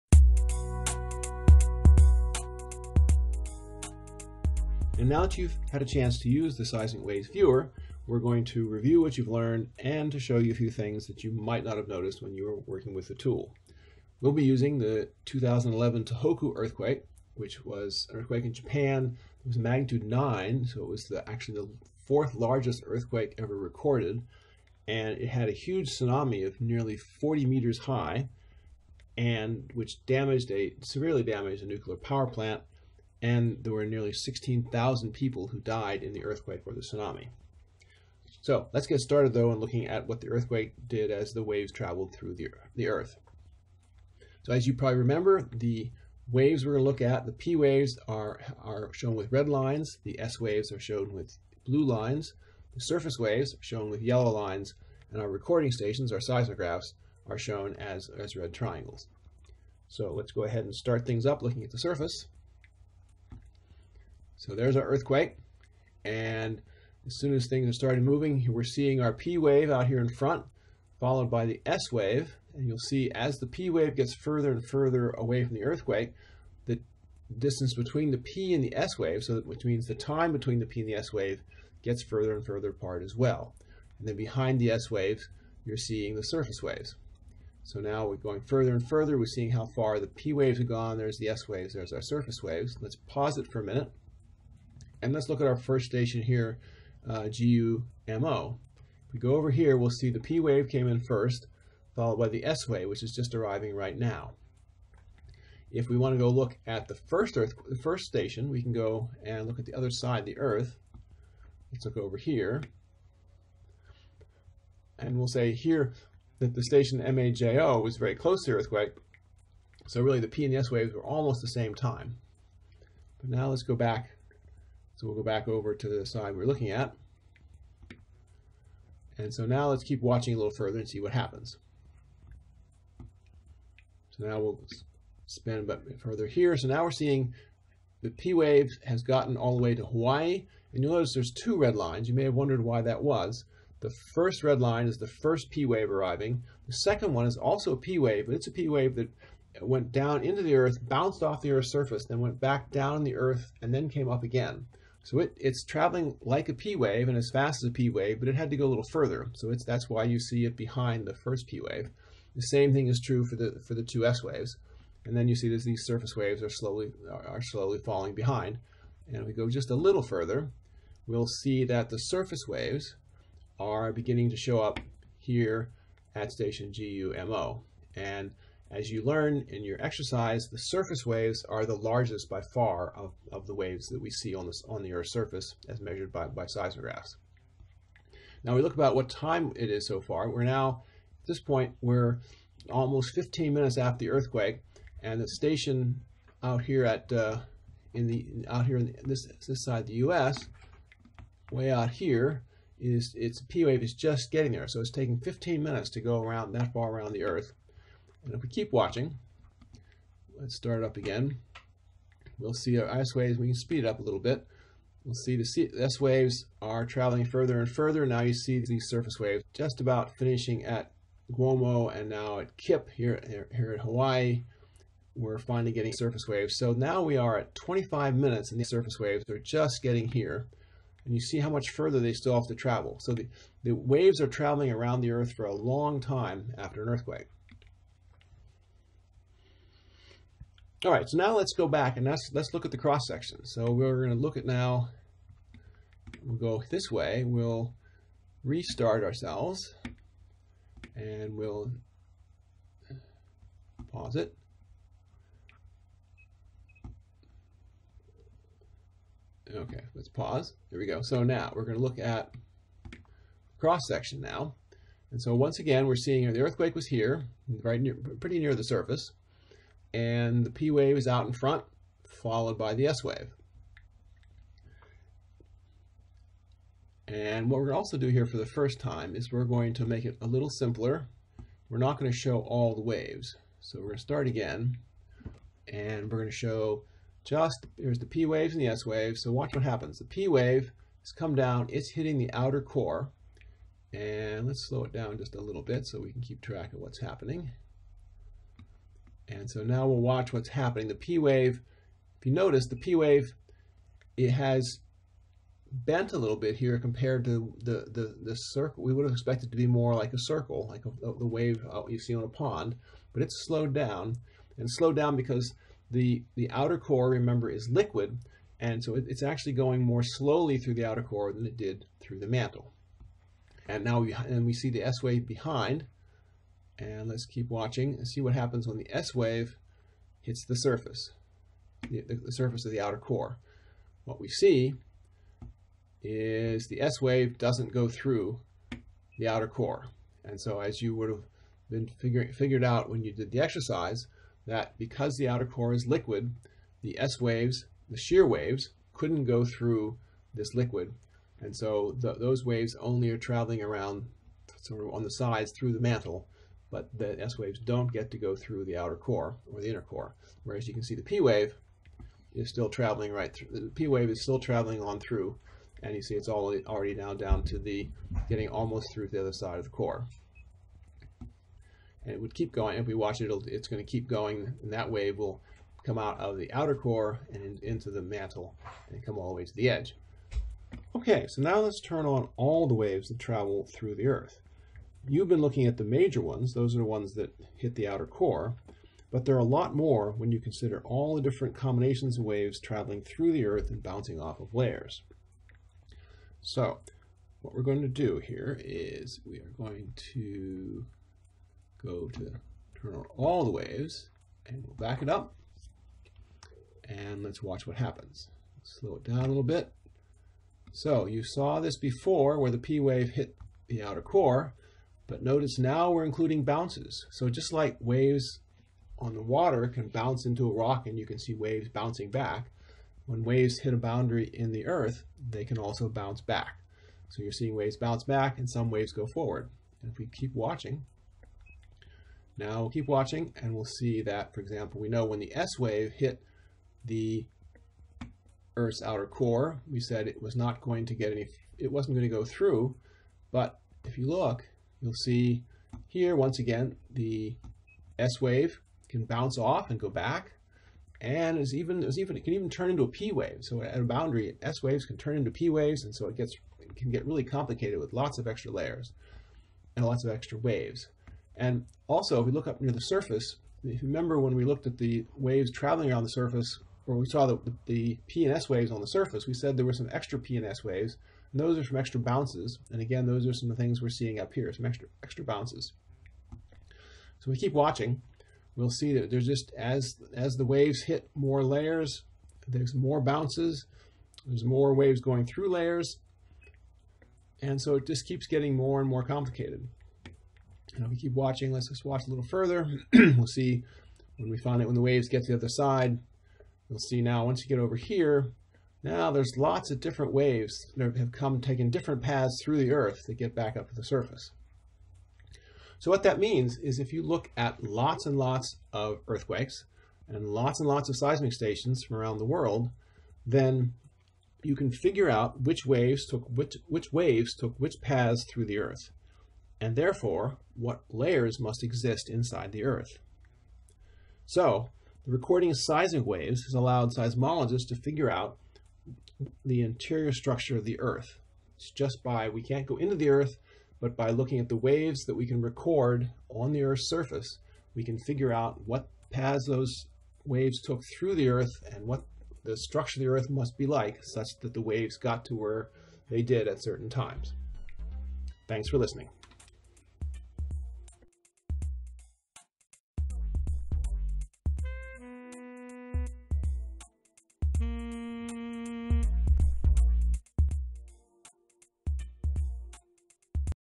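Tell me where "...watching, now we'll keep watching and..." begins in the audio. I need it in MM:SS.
07:10.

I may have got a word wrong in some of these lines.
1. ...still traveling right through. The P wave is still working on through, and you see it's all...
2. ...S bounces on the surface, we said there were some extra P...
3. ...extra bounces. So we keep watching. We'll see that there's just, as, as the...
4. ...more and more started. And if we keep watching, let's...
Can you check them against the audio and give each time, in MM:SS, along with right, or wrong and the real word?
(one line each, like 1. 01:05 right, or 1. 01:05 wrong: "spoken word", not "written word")
1. 06:02 wrong: "traveling", not "working"
2. 07:48 wrong: "waves", not "bounces"
3. 07:55 right
4. 08:08 wrong: "complicated", not "started".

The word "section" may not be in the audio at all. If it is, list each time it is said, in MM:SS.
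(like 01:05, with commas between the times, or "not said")
04:03, 04:23.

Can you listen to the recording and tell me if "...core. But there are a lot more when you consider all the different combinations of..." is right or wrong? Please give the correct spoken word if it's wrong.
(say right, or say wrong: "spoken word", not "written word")
right.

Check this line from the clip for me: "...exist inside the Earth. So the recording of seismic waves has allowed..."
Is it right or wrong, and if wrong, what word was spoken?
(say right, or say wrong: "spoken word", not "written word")
right.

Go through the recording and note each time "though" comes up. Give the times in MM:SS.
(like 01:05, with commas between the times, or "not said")
00:39.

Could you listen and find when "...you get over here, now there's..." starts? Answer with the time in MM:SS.
08:17.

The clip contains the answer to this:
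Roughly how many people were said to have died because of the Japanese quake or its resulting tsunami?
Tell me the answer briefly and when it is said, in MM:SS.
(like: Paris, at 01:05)
16,000, at 00:34.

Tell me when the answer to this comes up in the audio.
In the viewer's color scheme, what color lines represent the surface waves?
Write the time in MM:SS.
00:54.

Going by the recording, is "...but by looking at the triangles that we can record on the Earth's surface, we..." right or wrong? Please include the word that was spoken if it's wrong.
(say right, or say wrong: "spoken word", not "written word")
wrong: "waves", not "triangles".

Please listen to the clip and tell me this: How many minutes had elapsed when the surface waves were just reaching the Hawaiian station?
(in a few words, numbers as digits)
25 minutes.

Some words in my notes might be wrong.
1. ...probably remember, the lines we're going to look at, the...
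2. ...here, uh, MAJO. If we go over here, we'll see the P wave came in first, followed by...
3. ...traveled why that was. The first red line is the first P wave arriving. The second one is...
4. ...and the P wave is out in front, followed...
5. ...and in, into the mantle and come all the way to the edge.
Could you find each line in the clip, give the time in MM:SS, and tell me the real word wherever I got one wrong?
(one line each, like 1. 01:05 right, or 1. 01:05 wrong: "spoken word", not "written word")
1. 00:44 wrong: "waves", not "lines"
2. 01:36 wrong: "GUMO", not "MAJO"
3. 02:22 wrong: "wondered", not "traveled"
4. 04:29 right
5. 06:17 right.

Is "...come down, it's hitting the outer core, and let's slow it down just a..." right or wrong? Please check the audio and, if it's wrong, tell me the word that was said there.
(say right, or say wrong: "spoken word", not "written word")
right.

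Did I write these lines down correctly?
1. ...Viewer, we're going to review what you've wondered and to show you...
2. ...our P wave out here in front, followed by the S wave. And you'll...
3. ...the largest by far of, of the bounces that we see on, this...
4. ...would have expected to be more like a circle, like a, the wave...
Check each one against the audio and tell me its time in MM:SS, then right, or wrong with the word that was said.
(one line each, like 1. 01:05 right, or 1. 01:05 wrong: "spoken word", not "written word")
1. 00:07 wrong: "learned", not "wondered"
2. 01:08 right
3. 03:01 wrong: "waves", not "bounces"
4. 05:08 right.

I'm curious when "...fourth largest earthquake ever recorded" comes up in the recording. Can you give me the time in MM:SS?
00:22.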